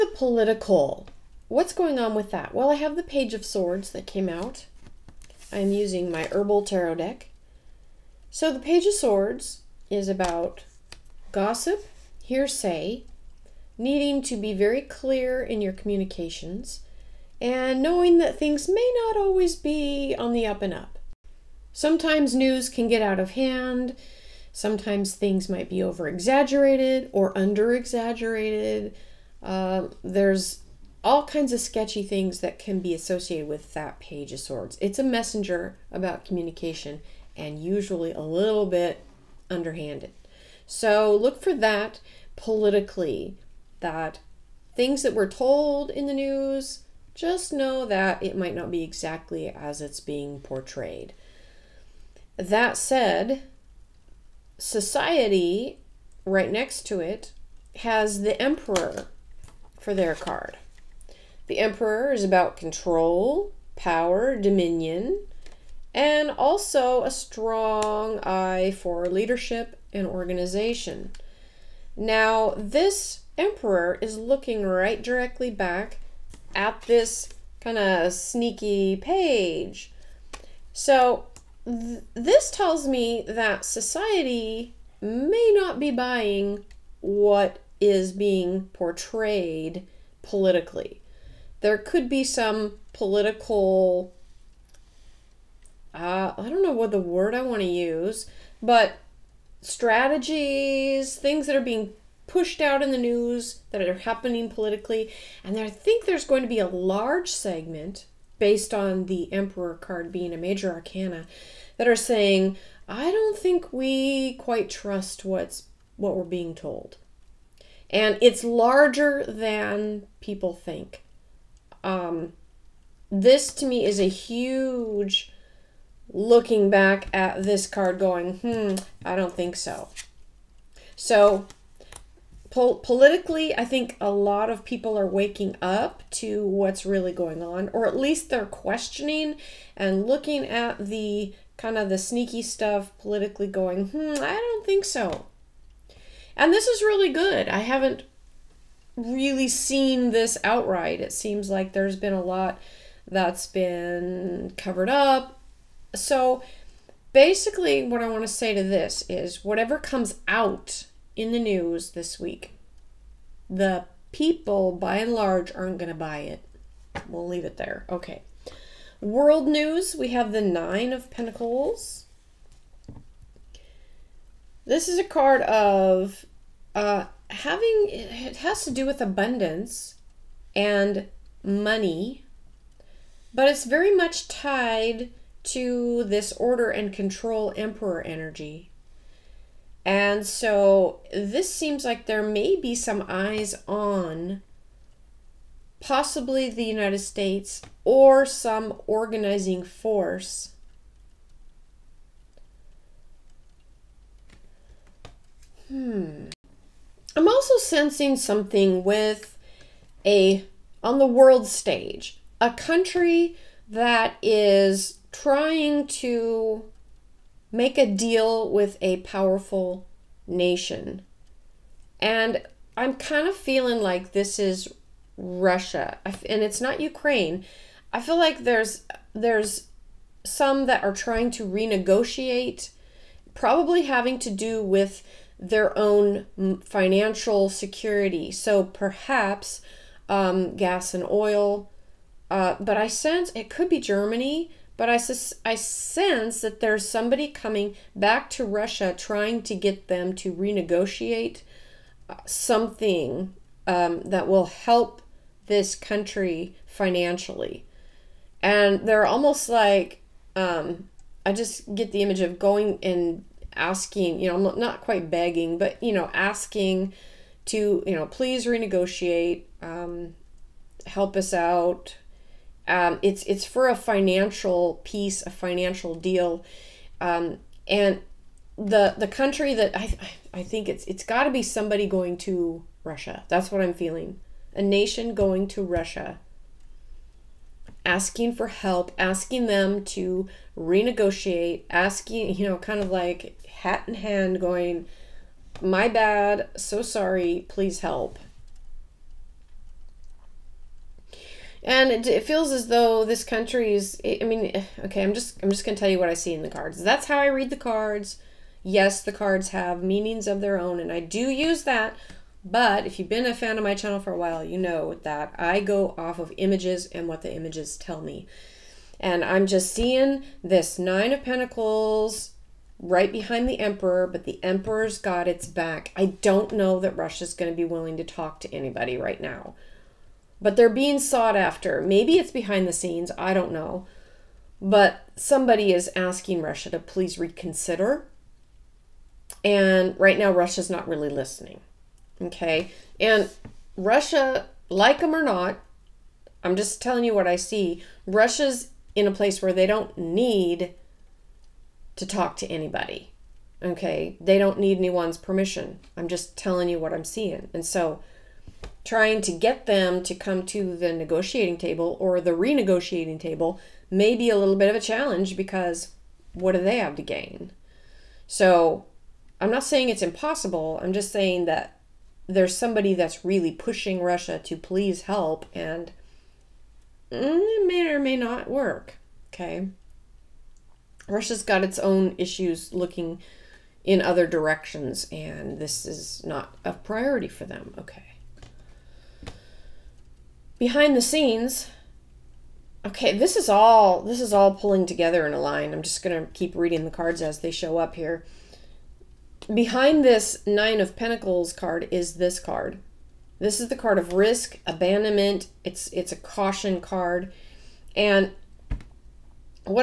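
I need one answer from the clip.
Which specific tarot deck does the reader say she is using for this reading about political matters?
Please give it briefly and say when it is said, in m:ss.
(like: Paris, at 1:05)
Herbal Tarot, at 0:06.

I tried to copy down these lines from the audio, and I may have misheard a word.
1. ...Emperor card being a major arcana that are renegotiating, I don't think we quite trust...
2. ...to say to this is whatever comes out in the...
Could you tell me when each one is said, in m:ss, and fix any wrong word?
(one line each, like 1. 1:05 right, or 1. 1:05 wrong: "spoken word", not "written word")
1. 1:49 wrong: "saying", not "renegotiating"
2. 2:38 right.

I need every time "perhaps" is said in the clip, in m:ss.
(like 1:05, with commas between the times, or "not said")
3:58.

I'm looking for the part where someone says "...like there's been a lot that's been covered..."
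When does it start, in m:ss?
2:31.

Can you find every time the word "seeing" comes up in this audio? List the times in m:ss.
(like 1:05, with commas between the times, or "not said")
5:19, 5:57.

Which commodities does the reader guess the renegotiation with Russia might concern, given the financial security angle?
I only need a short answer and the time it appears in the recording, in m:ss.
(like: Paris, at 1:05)
Gas and oil, at 4:00.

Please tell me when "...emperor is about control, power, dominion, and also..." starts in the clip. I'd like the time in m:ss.
1:01.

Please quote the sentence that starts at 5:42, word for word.
And Russia, like them or not, I'm just telling you what I see.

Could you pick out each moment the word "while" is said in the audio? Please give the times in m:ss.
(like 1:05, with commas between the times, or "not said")
5:14.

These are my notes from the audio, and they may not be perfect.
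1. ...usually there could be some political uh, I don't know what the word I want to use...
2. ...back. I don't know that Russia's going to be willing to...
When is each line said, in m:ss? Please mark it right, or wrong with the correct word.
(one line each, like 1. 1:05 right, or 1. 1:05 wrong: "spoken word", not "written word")
1. 1:30 wrong: "politically", not "usually"
2. 5:25 right.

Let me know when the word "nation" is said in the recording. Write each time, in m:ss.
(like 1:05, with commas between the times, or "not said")
3:40, 4:44.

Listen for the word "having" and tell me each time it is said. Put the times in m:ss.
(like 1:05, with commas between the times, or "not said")
2:57, 3:53.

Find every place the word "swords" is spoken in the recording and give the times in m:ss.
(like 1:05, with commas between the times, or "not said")
0:03, 0:08, 0:34.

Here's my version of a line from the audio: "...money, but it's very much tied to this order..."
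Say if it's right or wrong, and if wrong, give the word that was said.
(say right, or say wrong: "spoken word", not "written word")
right.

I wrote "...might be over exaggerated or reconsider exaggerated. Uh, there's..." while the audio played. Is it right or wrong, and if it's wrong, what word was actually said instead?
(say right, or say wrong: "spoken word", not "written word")
wrong: "under", not "reconsider".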